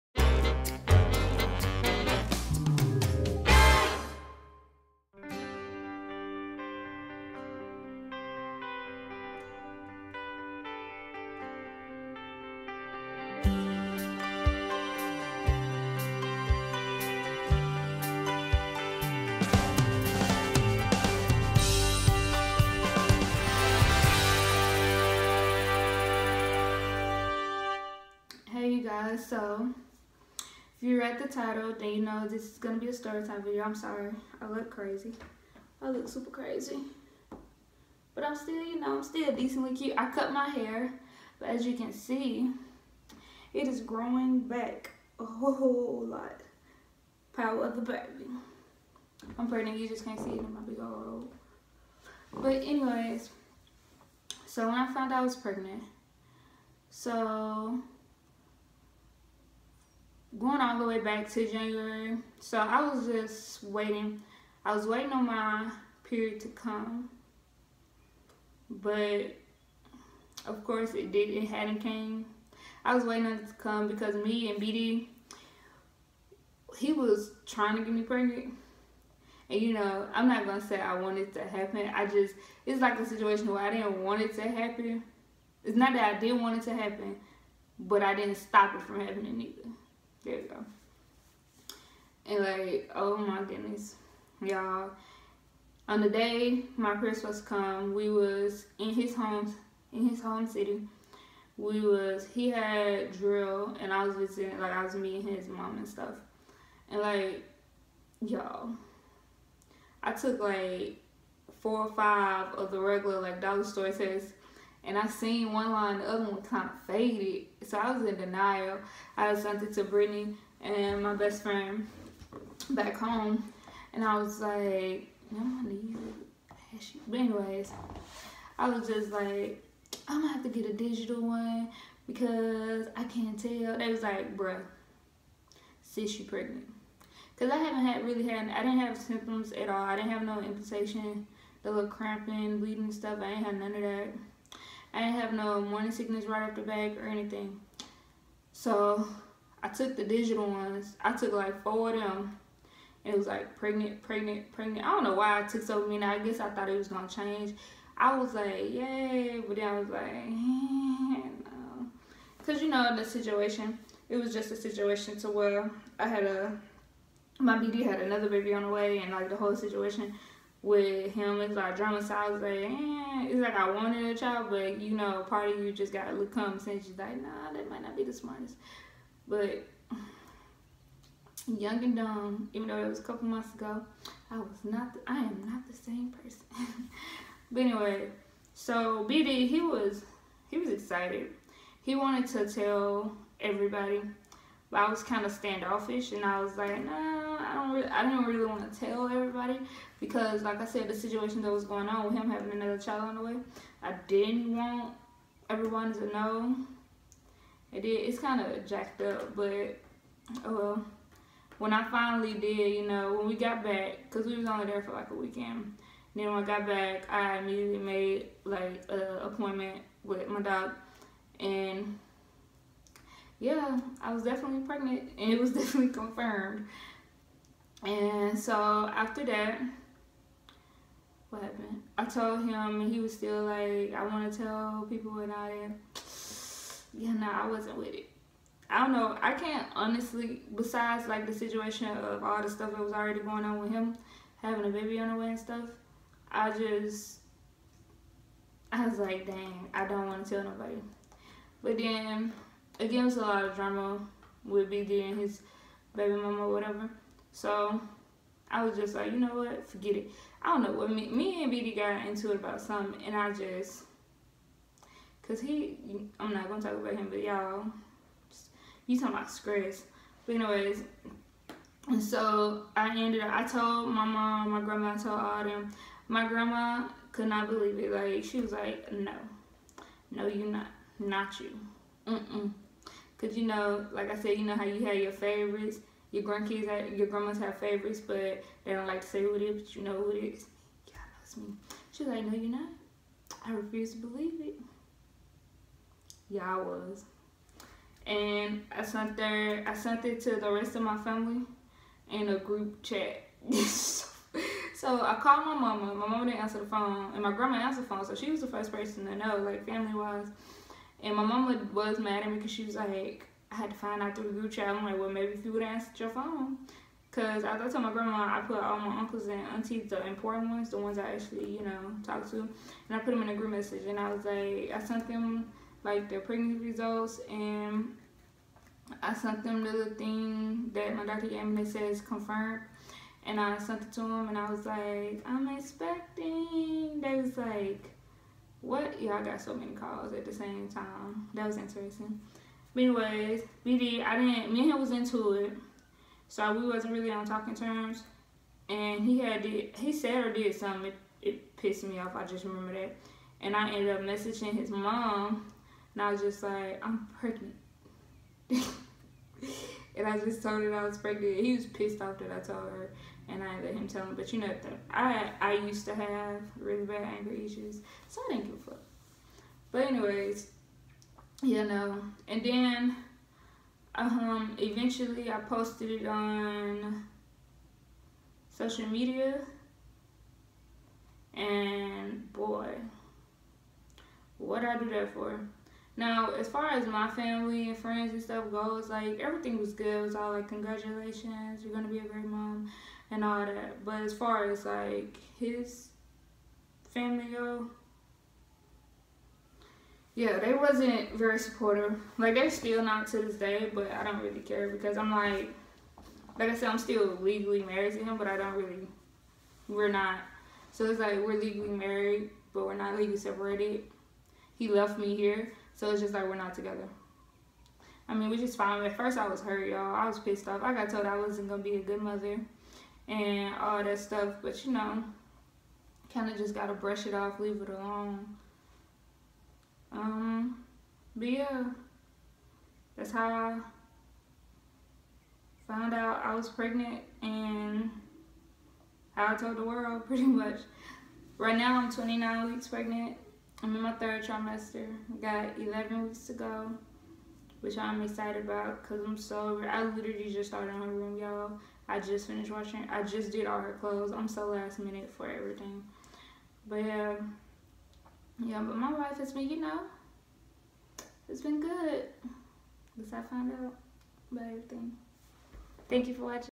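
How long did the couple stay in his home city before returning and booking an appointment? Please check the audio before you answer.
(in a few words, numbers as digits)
A weekend.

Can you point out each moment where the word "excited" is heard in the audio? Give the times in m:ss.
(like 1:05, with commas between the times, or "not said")
3:10, 7:28.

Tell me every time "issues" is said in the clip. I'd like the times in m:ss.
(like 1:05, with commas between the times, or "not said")
6:07.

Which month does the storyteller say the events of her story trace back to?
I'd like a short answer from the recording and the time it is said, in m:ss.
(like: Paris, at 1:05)
January, at 1:01.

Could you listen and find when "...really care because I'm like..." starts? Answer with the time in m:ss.
6:44.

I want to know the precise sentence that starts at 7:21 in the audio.
Right now I'm 29 weeks pregnant.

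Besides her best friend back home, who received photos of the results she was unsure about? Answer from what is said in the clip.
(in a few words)
Brittany.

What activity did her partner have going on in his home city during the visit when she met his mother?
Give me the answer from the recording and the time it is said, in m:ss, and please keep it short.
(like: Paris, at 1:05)
Drill, at 1:43.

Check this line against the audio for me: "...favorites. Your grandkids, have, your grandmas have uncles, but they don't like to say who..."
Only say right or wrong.
wrong.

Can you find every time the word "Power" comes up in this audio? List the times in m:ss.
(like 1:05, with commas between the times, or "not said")
0:47.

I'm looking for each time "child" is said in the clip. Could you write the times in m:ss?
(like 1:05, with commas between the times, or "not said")
2:54, 3:22.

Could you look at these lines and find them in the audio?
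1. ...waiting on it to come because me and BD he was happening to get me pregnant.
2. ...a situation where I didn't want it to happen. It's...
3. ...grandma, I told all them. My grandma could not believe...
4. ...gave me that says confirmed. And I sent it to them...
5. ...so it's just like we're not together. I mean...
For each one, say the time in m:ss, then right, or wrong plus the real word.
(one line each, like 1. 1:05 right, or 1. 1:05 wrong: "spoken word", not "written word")
1. 1:13 wrong: "trying", not "happening"
2. 1:22 right
3. 4:34 right
4. 5:31 right
5. 6:55 right.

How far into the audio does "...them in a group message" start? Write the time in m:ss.
5:23.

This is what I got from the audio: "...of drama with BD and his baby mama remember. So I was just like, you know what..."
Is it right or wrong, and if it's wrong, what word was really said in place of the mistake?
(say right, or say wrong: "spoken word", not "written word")
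wrong: "whatever", not "remember".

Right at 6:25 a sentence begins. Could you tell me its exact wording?
Now, as far as my family and friends and stuff goes, like everything was good.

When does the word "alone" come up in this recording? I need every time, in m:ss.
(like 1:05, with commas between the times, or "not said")
7:07.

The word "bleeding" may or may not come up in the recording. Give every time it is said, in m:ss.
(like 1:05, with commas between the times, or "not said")
2:22.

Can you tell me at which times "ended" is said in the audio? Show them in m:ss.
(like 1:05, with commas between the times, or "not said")
4:32, 5:53.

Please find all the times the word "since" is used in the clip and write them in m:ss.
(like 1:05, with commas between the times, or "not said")
2:56.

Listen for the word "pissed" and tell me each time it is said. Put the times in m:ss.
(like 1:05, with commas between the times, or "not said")
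5:51, 6:01, 7:00.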